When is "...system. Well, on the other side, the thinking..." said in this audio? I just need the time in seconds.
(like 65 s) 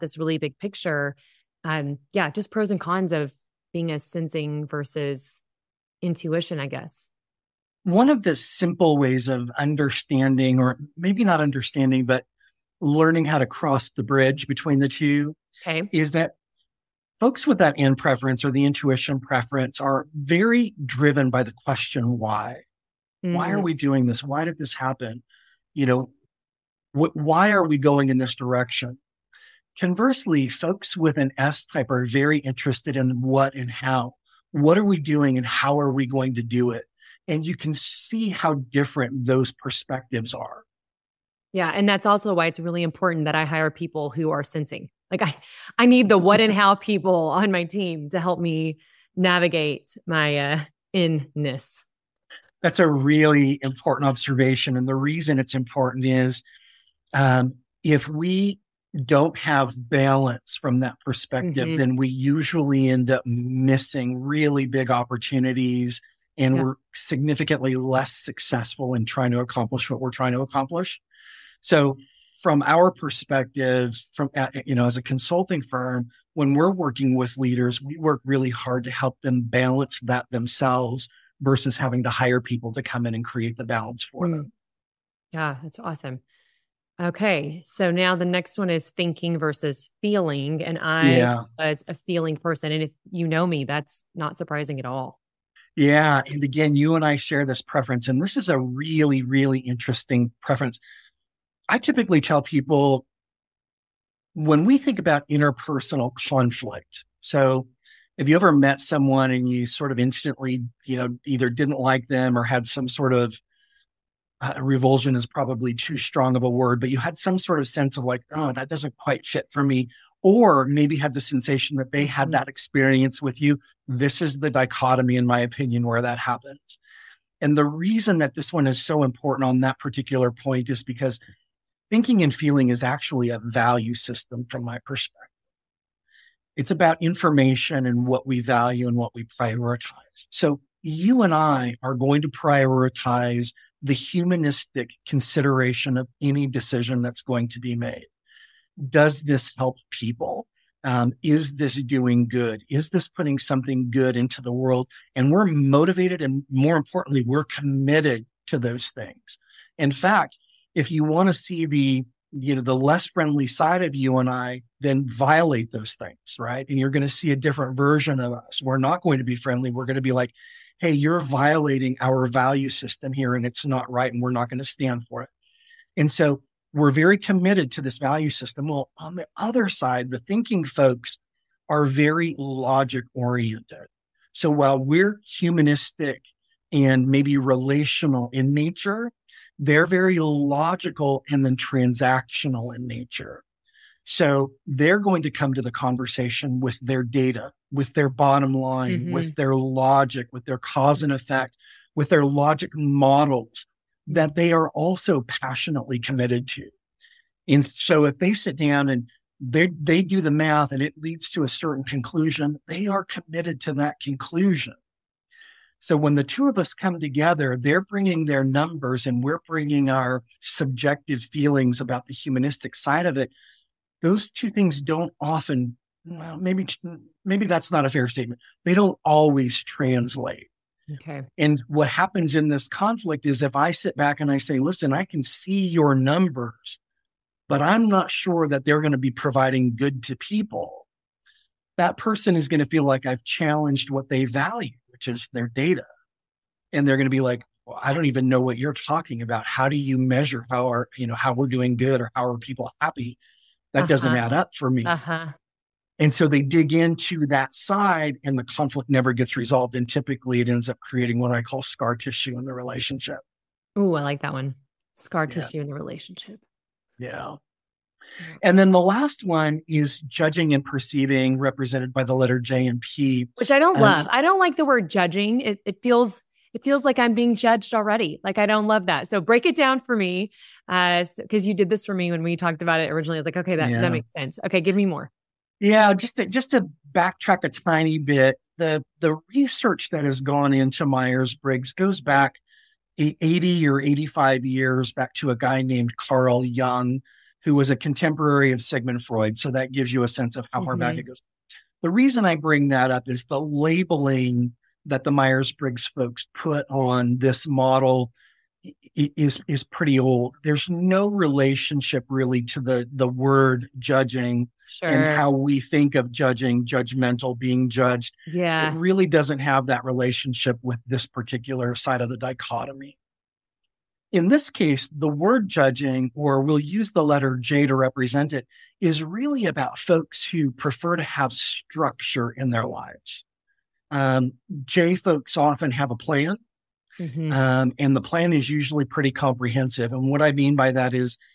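178 s.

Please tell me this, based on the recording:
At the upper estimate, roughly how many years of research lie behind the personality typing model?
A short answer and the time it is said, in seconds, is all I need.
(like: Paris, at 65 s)
85, at 293 s.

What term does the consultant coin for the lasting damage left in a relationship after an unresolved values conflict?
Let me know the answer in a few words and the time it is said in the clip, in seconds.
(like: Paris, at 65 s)
Scar tissue, at 261 s.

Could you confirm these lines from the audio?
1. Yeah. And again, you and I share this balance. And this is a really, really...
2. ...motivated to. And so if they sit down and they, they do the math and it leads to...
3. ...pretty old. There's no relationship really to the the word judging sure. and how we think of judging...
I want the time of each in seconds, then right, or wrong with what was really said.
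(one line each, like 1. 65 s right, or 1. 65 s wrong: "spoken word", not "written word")
1. 95 s wrong: "preference", not "balance"
2. 205 s wrong: "committed", not "motivated"
3. 309 s right.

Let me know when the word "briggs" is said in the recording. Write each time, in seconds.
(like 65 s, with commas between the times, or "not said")
290 s, 305 s.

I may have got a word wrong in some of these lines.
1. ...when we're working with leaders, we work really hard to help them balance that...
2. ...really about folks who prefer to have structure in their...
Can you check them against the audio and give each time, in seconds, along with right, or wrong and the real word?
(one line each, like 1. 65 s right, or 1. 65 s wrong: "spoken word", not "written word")
1. 76 s right
2. 329 s right.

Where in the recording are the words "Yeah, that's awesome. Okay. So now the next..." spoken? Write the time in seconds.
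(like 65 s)
85 s.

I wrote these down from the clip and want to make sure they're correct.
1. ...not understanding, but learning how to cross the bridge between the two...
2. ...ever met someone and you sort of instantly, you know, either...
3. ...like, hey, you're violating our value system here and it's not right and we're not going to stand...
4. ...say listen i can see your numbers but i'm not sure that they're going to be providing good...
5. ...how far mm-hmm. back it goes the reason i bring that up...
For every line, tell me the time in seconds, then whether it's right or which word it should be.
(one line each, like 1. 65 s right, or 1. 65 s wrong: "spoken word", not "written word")
1. 11 s right
2. 108 s right
3. 170 s right
4. 234 s right
5. 300 s right.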